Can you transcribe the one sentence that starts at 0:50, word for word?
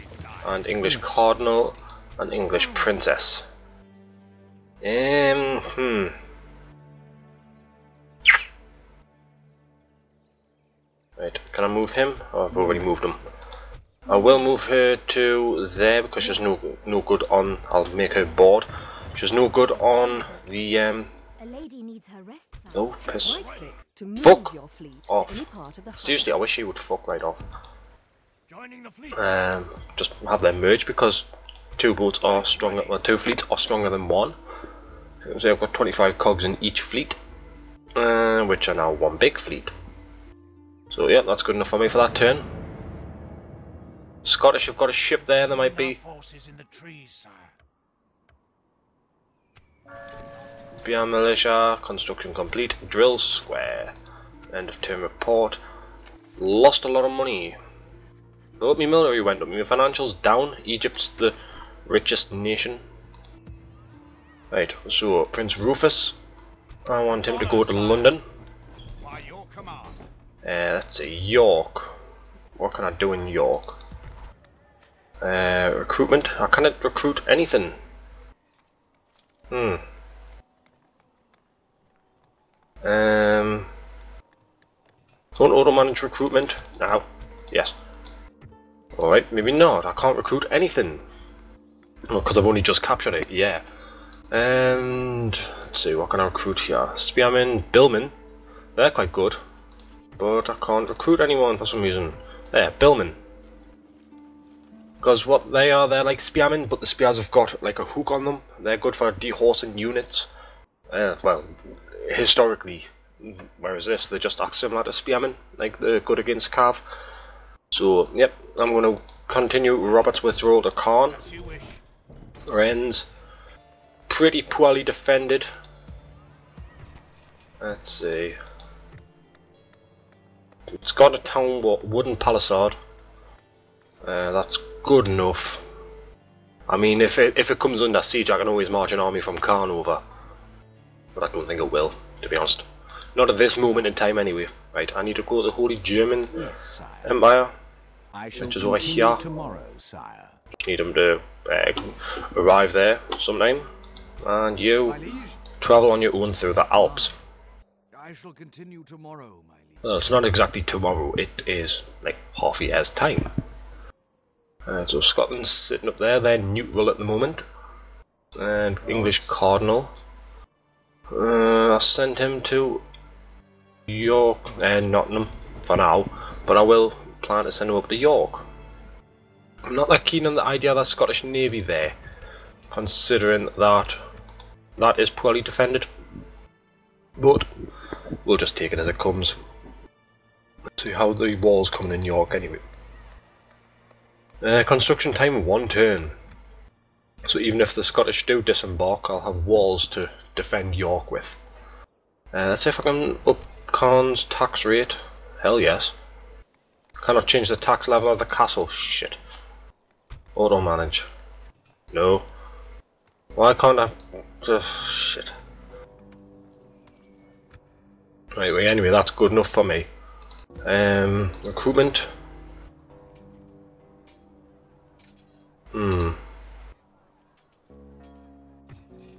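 BR Militia, construction complete, drill square.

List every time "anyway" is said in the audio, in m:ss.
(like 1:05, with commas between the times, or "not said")
2:24, 3:12, 3:38.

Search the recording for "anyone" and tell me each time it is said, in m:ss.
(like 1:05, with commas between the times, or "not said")
1:41.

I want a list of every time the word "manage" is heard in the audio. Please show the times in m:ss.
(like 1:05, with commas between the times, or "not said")
1:25, 3:30.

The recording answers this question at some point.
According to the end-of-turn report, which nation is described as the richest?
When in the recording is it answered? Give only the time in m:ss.
1:00.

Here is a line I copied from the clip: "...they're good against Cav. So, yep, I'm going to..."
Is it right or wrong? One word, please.
right.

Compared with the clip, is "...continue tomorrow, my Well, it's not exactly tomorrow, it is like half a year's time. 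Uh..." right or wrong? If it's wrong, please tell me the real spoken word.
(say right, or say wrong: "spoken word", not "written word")
right.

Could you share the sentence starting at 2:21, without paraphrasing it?
But I don't think it will, to be honest.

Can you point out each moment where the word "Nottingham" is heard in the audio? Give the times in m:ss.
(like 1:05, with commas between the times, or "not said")
2:54.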